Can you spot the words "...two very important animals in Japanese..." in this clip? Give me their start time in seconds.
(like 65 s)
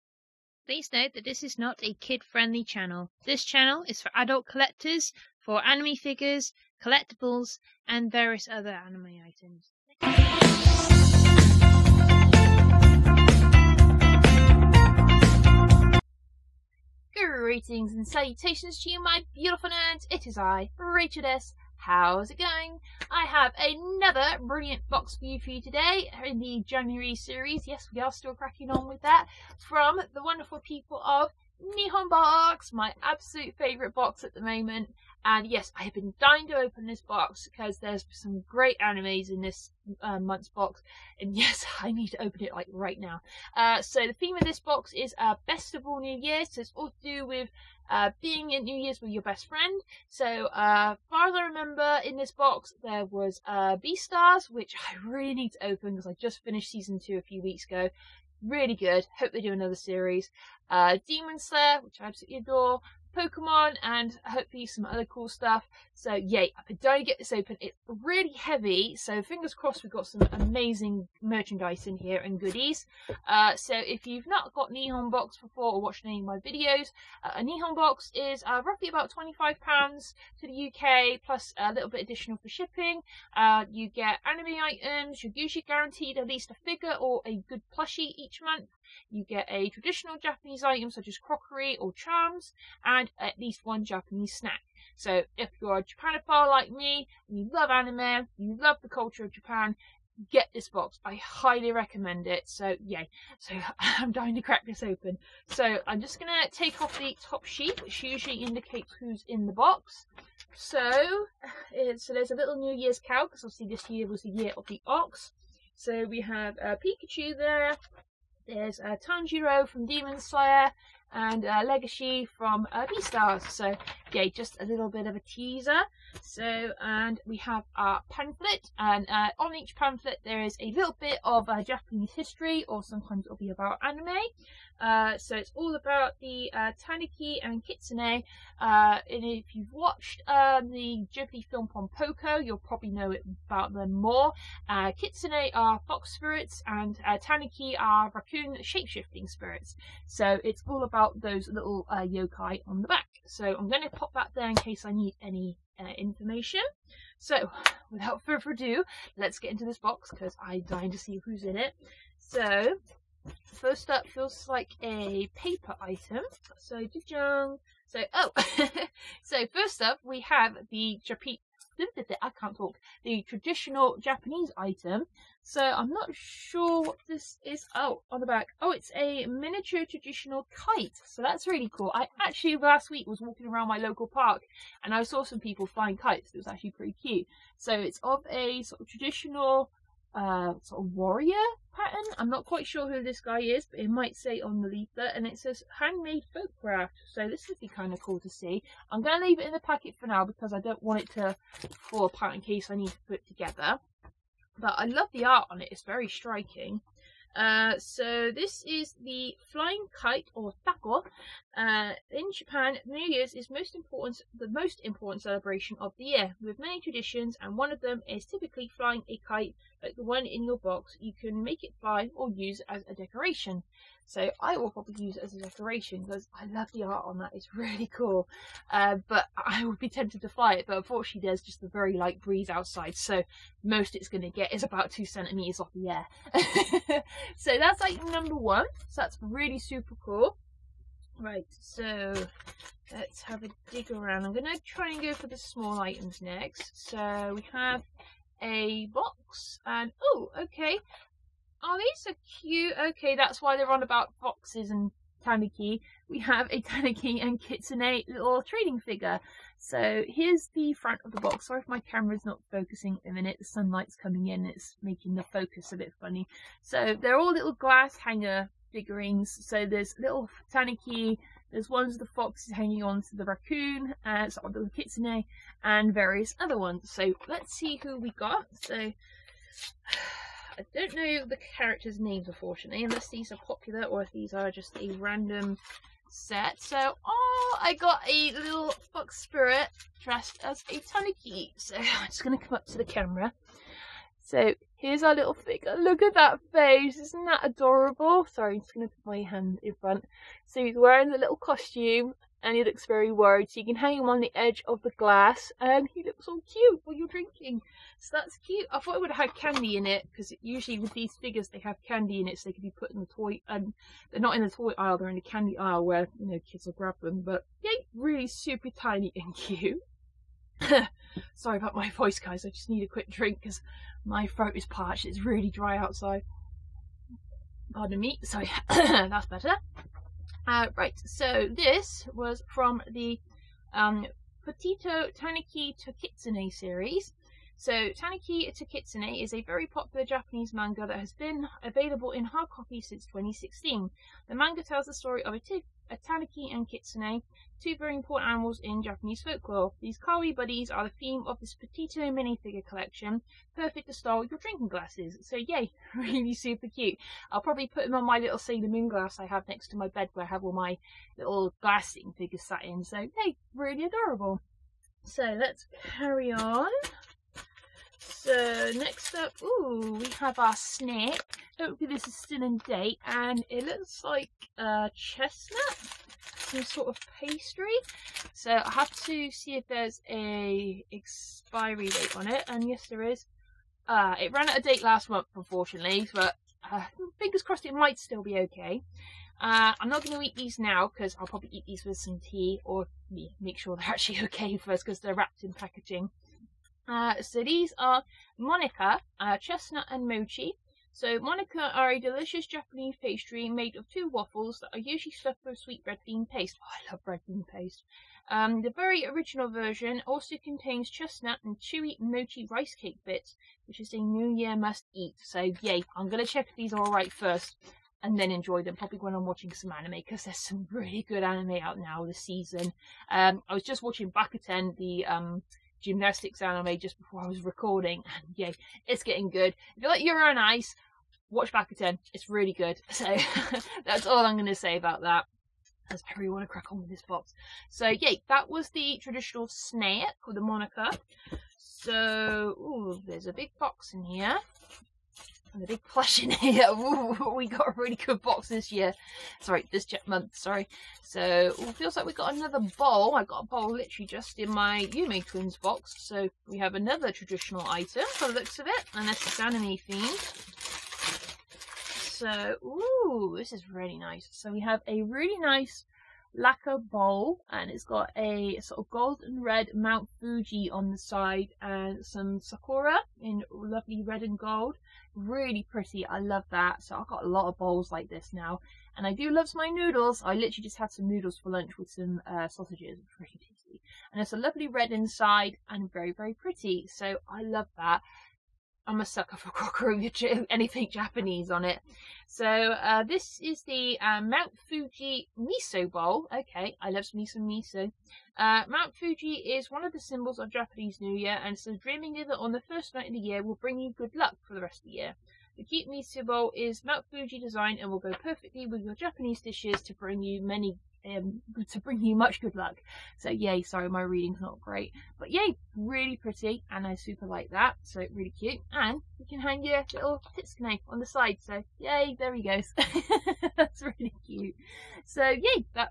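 347 s.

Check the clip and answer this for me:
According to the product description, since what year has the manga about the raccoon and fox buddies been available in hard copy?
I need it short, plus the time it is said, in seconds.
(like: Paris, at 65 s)
2016, at 343 s.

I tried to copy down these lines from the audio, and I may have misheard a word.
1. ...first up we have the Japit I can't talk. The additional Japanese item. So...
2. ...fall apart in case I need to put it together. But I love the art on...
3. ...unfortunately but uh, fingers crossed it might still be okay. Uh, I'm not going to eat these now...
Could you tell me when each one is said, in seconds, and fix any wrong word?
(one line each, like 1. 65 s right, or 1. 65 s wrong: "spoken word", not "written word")
1. 169 s wrong: "traditional", not "additional"
2. 201 s right
3. 385 s right.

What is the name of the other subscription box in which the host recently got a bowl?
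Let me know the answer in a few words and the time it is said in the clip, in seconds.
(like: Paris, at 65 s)
Yume Twins, at 454 s.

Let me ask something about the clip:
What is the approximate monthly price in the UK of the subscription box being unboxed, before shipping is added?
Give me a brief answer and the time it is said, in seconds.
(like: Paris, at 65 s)
£25, at 79 s.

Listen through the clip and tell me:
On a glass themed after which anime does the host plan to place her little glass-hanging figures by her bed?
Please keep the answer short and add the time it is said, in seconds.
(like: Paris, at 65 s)
Sailor Moon, at 358 s.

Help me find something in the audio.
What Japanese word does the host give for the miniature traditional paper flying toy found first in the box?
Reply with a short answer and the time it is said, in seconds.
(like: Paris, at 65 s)
Tako, at 210 s.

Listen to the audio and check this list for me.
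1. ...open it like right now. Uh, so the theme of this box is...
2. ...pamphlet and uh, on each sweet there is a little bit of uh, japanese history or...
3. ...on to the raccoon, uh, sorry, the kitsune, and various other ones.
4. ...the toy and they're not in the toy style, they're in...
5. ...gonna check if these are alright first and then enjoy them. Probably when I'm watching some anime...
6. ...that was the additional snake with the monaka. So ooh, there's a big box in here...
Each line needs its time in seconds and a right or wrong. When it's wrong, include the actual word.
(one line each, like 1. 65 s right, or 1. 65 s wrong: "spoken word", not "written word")
1. 42 s right
2. 128 s wrong: "pamphlet", not "sweet"
3. 272 s right
4. 313 s wrong: "aisle", not "style"
5. 416 s right
6. 438 s wrong: "traditional", not "additional".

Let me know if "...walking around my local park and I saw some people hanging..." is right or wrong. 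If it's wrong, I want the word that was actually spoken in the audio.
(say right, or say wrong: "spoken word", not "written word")
wrong: "flying", not "hanging".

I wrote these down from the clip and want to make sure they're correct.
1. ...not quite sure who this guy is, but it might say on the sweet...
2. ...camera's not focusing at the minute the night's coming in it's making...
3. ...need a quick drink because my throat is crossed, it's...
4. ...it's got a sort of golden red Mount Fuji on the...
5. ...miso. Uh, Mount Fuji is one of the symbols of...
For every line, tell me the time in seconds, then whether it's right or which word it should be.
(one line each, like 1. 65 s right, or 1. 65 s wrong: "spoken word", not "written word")
1. 192 s wrong: "leaflet", not "sweet"
2. 261 s wrong: "sunlight", not "night"
3. 322 s wrong: "parched", not "crossed"
4. 467 s right
5. 497 s right.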